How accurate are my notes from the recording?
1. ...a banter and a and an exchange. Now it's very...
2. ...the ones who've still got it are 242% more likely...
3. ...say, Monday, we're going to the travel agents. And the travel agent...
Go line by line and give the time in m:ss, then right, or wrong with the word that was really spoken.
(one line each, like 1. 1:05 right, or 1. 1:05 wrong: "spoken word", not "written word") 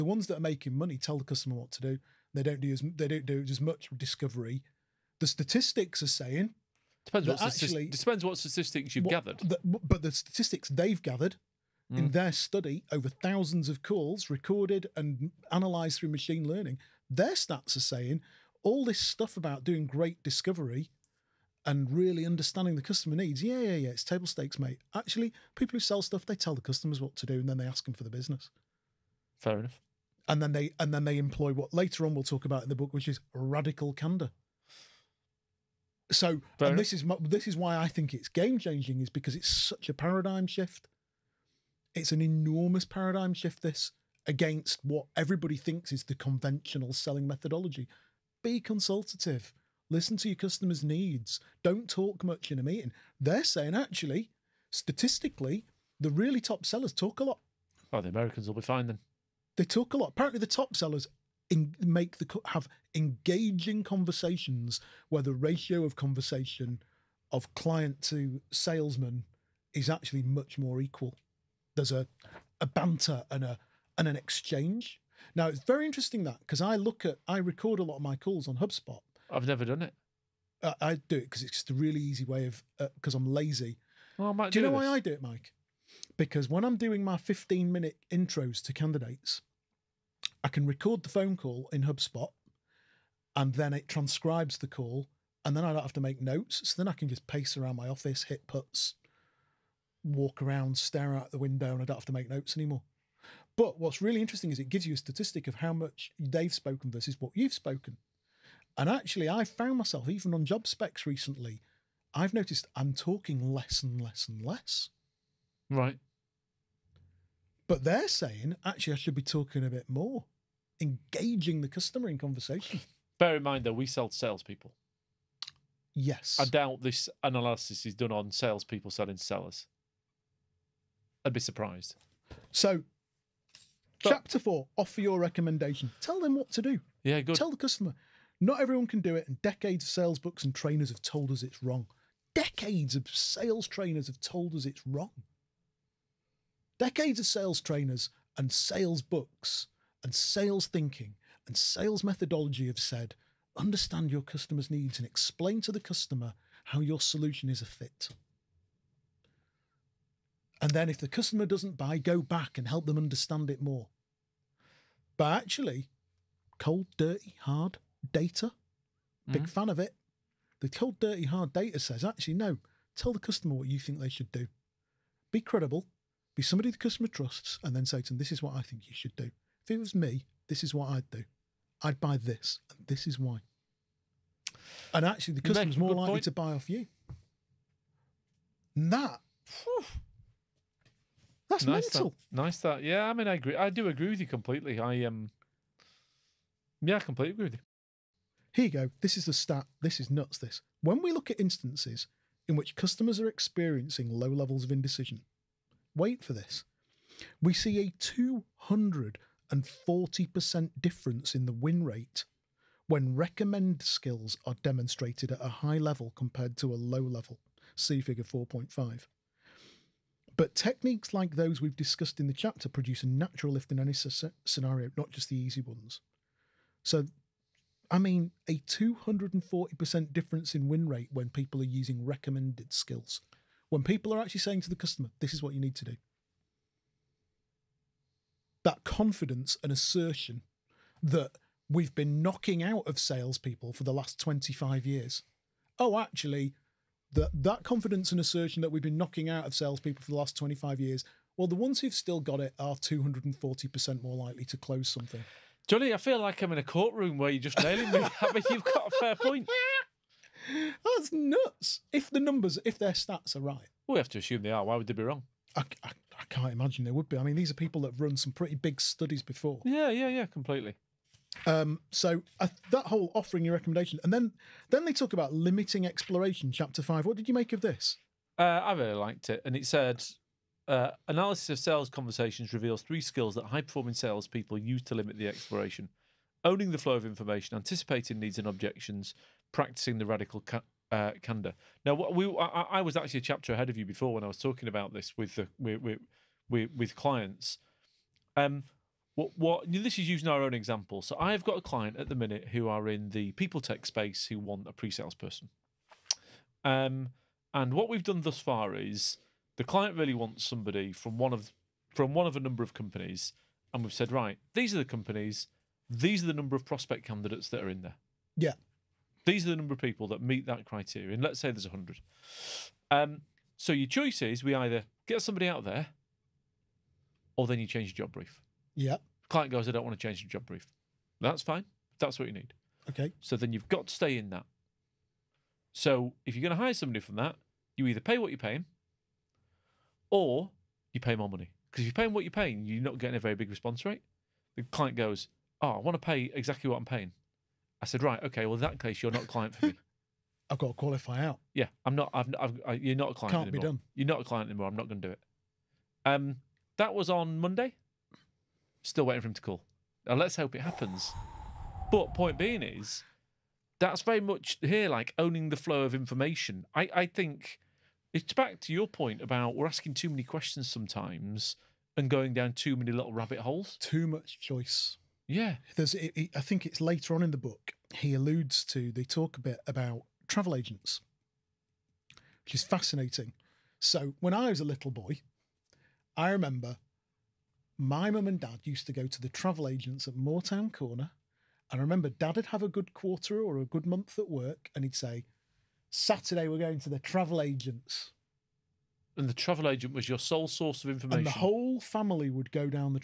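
1. 1:12 right
2. 4:11 wrong: "240", not "242"
3. 6:34 wrong: "Saturday", not "Monday".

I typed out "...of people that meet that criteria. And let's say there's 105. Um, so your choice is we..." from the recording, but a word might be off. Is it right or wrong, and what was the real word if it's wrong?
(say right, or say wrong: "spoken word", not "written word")
wrong: "100", not "105".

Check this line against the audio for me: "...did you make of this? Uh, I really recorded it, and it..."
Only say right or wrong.
wrong.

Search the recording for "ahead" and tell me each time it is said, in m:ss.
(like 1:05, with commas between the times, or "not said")
4:53.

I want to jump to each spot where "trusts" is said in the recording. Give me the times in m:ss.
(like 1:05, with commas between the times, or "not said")
2:57.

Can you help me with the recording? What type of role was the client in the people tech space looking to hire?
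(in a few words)
Pre-sales person.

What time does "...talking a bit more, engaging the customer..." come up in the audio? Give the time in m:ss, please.
1:59.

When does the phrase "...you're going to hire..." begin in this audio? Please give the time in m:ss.
5:36.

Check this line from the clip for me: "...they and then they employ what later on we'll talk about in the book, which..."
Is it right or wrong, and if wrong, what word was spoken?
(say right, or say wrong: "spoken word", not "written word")
right.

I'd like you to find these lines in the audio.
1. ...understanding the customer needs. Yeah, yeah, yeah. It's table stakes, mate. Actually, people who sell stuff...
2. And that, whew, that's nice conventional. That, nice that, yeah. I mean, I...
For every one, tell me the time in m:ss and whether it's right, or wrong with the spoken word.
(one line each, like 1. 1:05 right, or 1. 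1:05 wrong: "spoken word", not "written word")
1. 0:22 right
2. 3:08 wrong: "mental", not "conventional".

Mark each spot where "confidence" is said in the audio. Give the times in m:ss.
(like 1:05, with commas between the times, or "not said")
3:58, 4:07.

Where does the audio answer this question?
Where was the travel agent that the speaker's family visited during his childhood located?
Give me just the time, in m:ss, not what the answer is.
6:30.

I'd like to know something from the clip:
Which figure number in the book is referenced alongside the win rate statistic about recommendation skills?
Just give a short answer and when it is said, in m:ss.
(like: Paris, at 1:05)
4.5, at 3:38.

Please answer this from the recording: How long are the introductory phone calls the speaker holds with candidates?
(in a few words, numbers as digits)
15 minutes.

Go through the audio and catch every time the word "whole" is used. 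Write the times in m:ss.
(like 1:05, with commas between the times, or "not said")
4:32, 6:41.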